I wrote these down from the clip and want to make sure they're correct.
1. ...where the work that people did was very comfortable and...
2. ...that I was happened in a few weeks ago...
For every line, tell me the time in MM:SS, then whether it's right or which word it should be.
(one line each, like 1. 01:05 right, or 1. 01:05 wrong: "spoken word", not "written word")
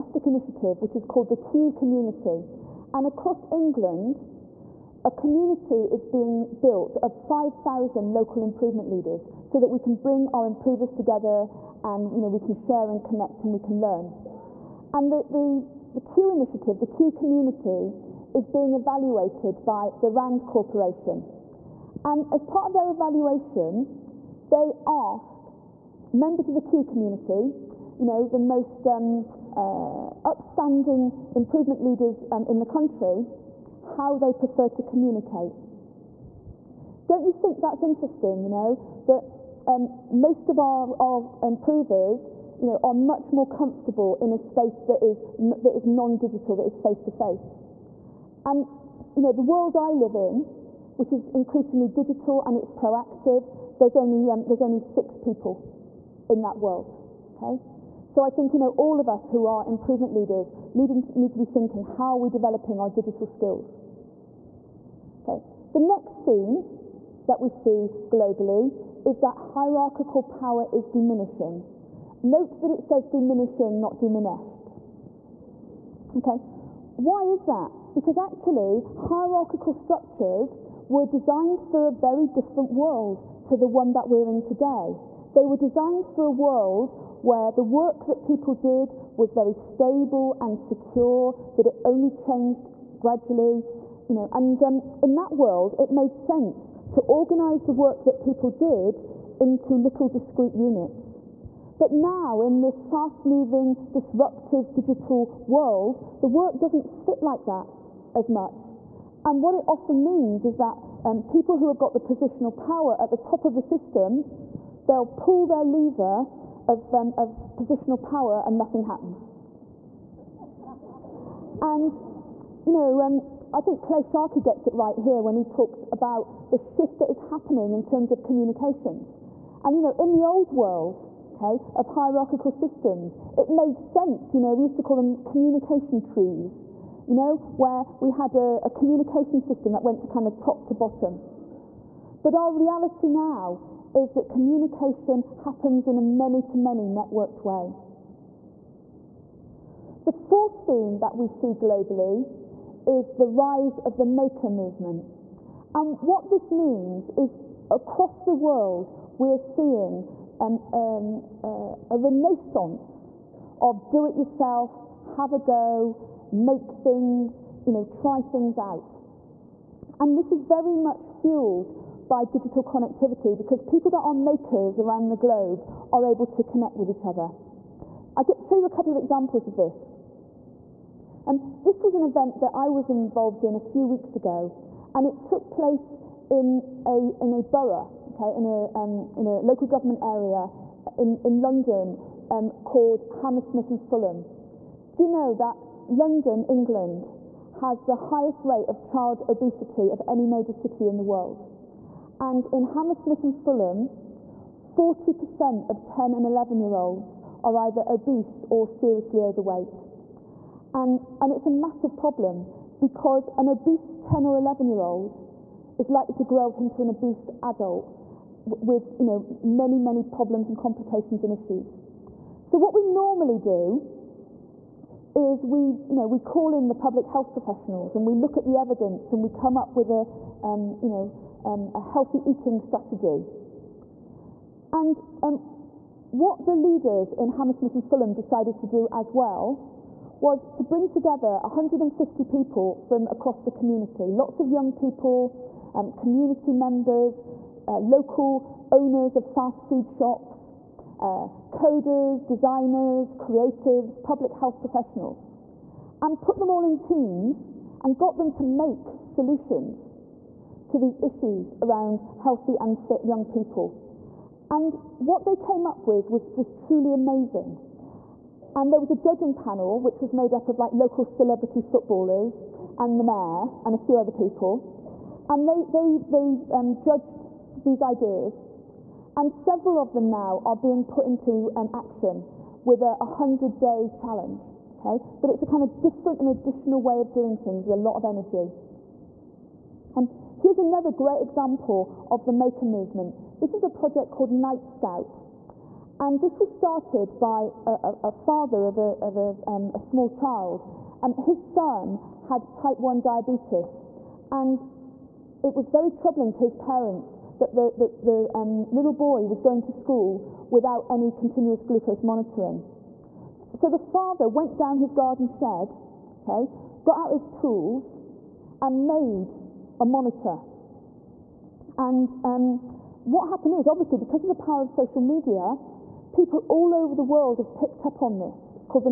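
1. 01:27 wrong: "stable", not "comfortable"
2. 03:02 wrong: "involved", not "happened".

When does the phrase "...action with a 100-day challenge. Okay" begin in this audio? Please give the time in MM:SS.
04:41.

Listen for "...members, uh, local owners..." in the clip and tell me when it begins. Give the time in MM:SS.
04:06.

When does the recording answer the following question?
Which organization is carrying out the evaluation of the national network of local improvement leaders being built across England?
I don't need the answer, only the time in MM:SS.
00:20.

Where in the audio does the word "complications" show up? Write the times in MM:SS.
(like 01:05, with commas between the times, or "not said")
03:40.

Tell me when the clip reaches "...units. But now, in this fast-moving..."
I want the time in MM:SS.
01:40.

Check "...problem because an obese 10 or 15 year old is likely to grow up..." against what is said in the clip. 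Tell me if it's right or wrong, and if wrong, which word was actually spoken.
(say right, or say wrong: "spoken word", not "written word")
wrong: "11", not "15".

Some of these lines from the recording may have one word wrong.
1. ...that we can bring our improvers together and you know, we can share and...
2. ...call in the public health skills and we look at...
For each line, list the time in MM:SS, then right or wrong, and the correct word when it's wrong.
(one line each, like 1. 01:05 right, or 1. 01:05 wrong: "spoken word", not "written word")
1. 00:09 right
2. 03:46 wrong: "professionals", not "skills".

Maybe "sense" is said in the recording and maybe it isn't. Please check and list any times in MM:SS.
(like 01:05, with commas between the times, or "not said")
01:36, 02:13.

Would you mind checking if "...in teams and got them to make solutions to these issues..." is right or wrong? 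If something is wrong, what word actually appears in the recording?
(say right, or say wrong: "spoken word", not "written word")
right.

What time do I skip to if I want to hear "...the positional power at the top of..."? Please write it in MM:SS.
01:51.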